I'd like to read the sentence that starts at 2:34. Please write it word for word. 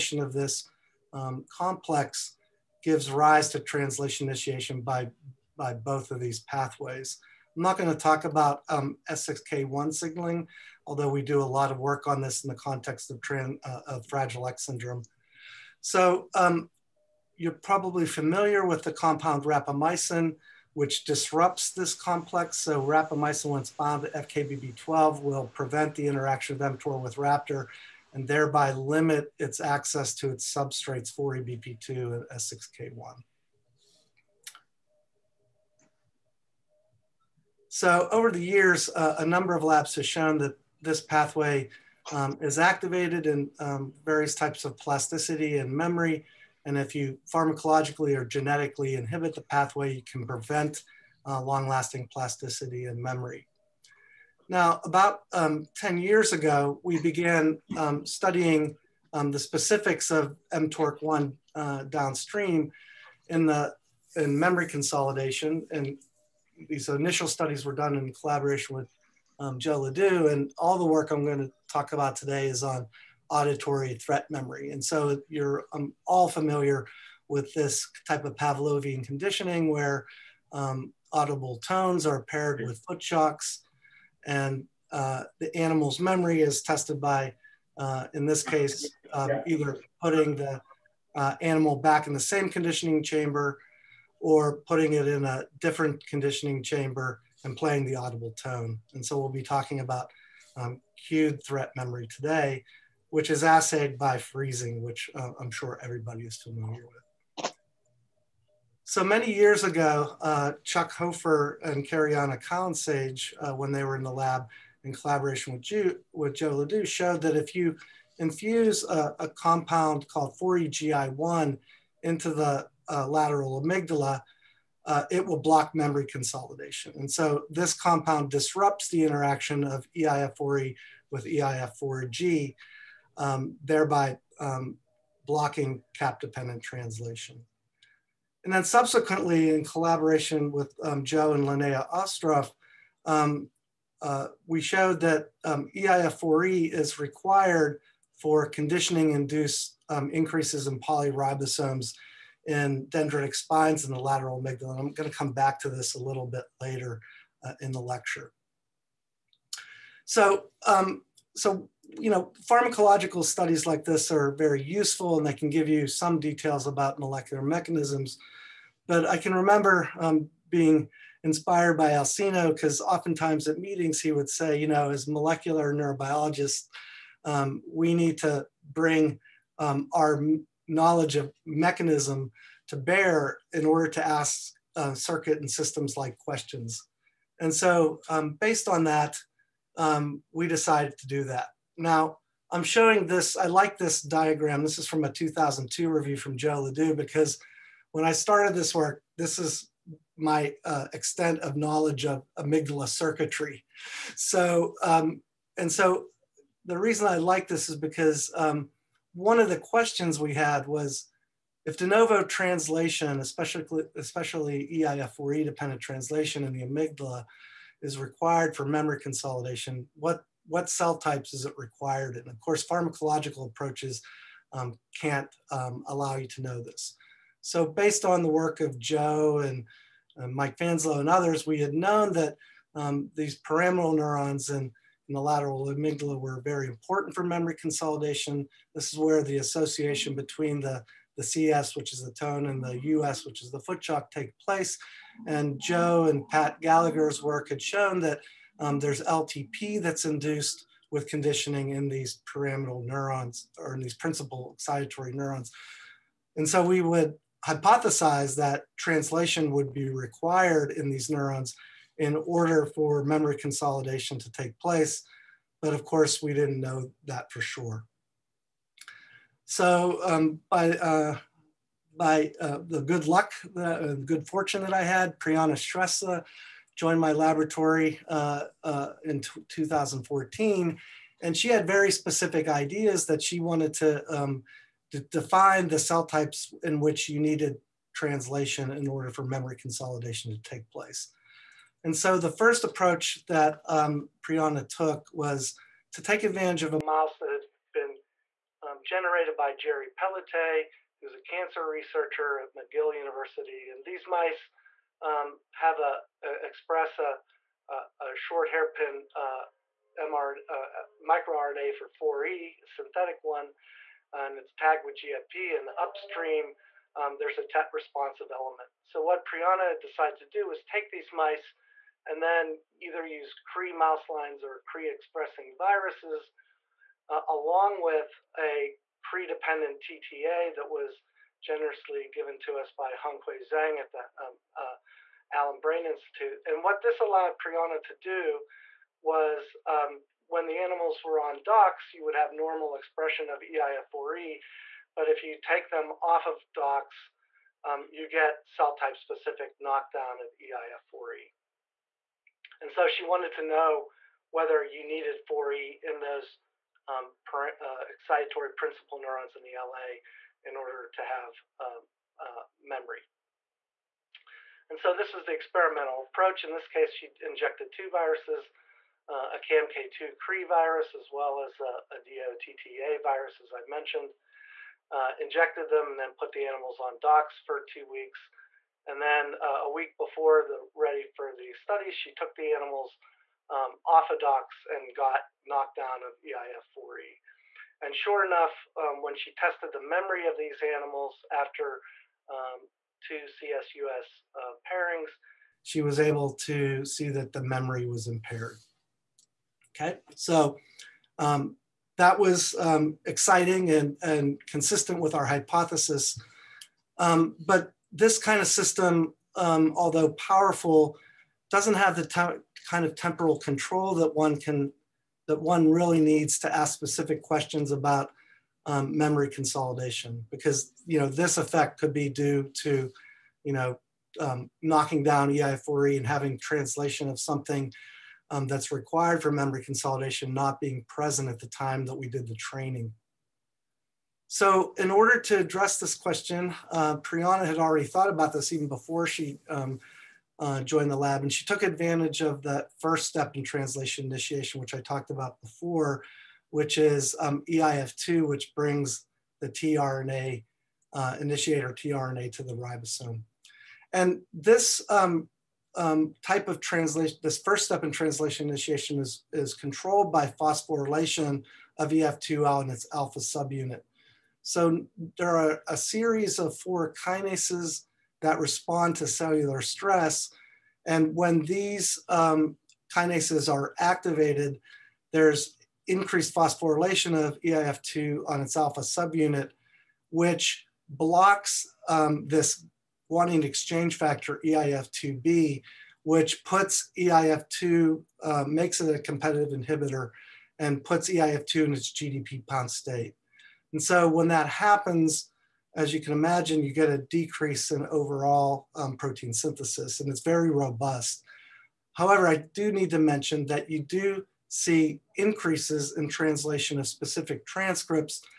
And I'm going to come back to this a little bit later uh, in the lecture.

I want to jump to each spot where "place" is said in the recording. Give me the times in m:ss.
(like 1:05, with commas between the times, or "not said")
4:04, 4:24, 4:50.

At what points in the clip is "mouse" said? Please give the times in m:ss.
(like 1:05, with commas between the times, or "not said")
4:56, 5:23.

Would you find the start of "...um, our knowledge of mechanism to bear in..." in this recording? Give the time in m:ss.
2:59.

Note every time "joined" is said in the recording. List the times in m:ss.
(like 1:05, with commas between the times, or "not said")
4:36, 7:20.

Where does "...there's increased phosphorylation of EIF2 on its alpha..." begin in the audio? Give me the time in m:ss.
7:55.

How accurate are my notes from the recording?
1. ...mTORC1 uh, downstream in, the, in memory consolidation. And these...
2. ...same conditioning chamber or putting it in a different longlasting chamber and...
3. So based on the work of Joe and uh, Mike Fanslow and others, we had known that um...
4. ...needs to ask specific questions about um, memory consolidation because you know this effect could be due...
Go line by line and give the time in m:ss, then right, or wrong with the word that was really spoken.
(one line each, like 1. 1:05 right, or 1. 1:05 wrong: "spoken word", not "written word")
1. 1:00 right
2. 1:32 wrong: "conditioning", not "longlasting"
3. 3:47 right
4. 6:55 right.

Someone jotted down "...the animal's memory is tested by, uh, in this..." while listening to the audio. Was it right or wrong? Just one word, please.
right.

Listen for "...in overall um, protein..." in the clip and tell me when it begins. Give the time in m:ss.
8:17.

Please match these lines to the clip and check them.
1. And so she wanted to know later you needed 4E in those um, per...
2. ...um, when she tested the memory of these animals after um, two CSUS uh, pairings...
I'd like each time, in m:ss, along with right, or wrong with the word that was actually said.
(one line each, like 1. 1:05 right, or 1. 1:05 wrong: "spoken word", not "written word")
1. 5:52 wrong: "whether", not "later"
2. 6:28 right.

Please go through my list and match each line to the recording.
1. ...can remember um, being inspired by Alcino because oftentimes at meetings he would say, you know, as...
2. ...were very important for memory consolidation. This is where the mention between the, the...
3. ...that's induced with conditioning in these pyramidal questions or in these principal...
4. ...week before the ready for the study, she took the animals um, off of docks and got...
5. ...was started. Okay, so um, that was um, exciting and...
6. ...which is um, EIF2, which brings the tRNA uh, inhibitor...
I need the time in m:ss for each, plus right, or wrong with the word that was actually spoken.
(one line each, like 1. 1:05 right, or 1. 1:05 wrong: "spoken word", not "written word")
1. 2:49 right
2. 3:56 wrong: "association", not "mention"
3. 4:09 wrong: "neurons", not "questions"
4. 6:19 right
5. 6:37 wrong: "impaired", not "started"
6. 7:26 wrong: "initiator", not "inhibitor".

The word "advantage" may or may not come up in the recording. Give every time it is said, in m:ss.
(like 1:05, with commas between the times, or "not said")
4:56, 7:21.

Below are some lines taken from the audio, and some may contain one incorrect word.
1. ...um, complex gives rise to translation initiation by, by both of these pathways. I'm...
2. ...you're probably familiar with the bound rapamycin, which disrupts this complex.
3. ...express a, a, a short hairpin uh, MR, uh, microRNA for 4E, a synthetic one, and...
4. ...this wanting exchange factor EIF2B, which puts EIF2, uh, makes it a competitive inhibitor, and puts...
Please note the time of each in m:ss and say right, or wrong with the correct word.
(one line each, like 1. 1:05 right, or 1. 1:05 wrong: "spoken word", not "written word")
1. 0:01 right
2. 0:17 wrong: "compound", not "bound"
3. 5:06 right
4. 8:02 right.